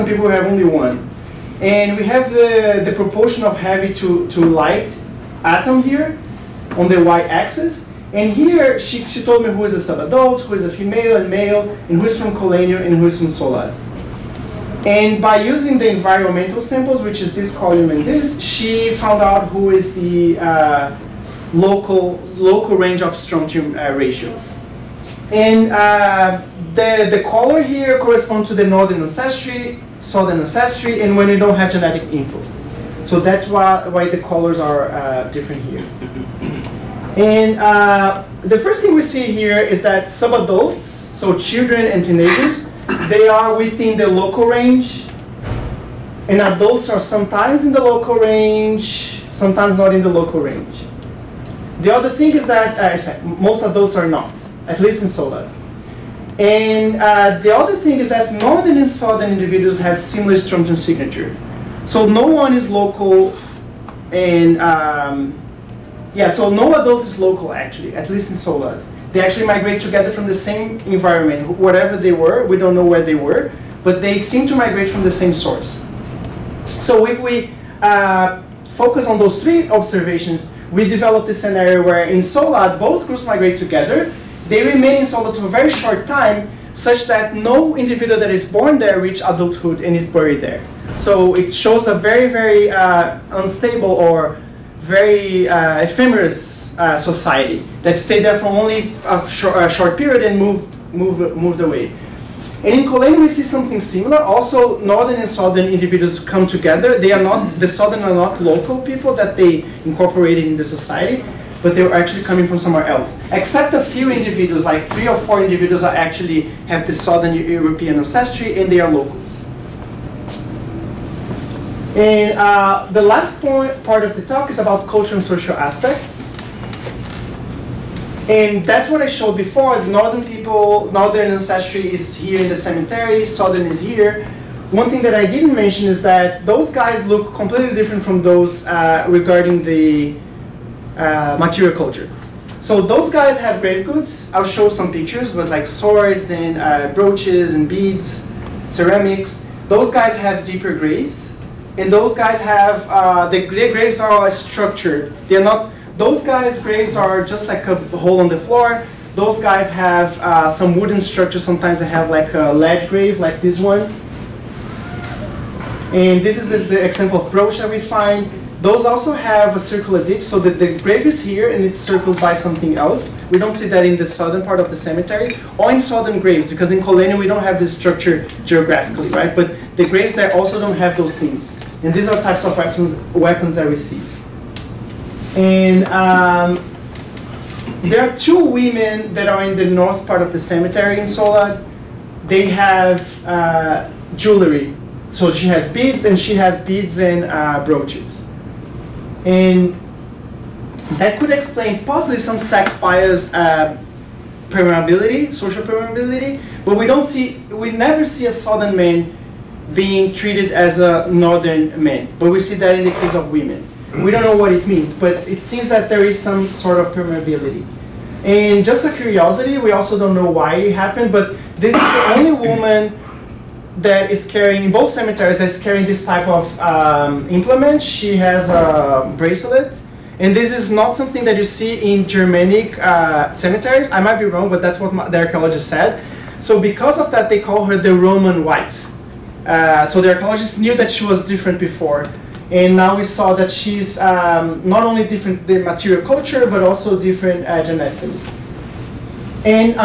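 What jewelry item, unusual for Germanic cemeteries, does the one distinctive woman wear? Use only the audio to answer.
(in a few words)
Bracelet.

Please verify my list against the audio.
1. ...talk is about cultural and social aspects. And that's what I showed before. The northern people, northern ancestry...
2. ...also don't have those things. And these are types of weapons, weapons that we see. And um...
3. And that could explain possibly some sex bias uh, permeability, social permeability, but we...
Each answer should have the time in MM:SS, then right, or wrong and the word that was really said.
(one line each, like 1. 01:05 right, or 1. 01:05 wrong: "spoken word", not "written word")
1. 02:04 right
2. 03:00 right
3. 03:19 right.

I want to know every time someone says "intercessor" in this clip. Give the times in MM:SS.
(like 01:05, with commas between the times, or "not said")
not said.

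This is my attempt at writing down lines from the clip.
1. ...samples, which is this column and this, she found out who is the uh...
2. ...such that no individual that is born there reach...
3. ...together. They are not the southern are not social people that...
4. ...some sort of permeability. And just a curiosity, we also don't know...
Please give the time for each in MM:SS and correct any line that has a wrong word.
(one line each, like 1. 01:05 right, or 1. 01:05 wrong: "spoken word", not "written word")
1. 00:16 right
2. 01:26 right
3. 01:46 wrong: "local", not "social"
4. 03:36 right.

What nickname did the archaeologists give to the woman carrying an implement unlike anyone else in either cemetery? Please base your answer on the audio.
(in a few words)
The Roman wife.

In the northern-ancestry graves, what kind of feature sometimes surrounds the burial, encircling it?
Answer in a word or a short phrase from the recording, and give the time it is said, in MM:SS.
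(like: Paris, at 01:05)
Circular ditch, at 02:49.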